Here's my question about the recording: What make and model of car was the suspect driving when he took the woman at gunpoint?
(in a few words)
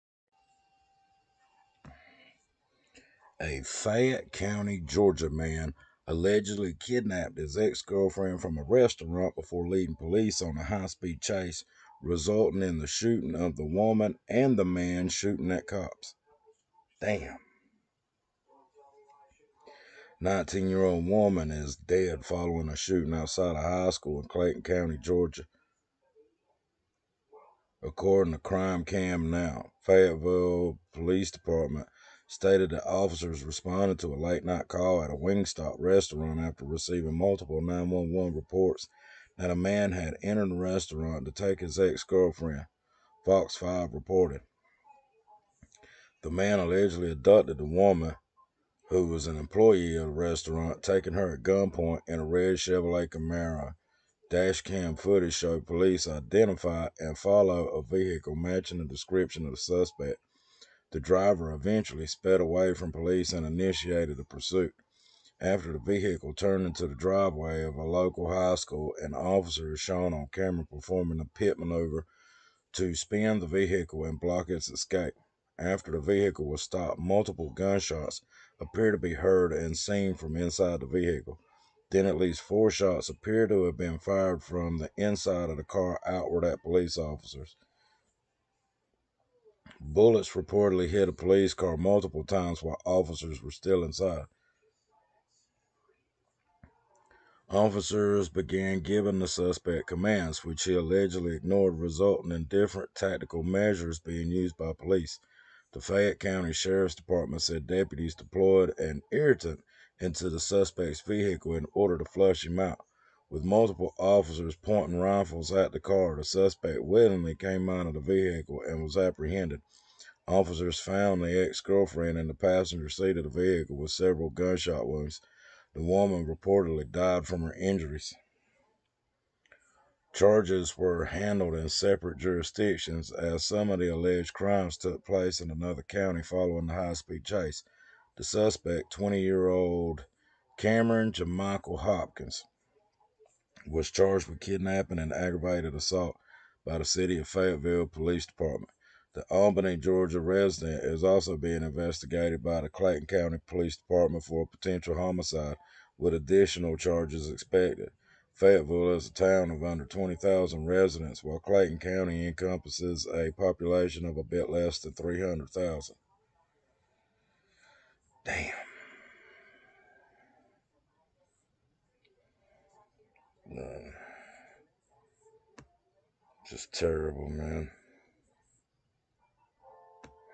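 Chevrolet Camaro.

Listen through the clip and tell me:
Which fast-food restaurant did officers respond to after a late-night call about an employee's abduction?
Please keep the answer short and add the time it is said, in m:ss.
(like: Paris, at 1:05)
Wingstop, at 0:35.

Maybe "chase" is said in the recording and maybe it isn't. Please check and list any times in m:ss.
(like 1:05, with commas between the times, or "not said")
0:11, 2:17.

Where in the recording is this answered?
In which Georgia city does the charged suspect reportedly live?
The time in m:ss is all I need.
2:29.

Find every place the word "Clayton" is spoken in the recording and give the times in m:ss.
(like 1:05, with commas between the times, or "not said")
0:24, 2:32, 2:41.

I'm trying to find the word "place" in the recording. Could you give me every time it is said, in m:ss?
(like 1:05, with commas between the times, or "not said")
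2:15.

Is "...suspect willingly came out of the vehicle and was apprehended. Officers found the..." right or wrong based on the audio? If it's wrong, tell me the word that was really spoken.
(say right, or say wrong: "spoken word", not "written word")
right.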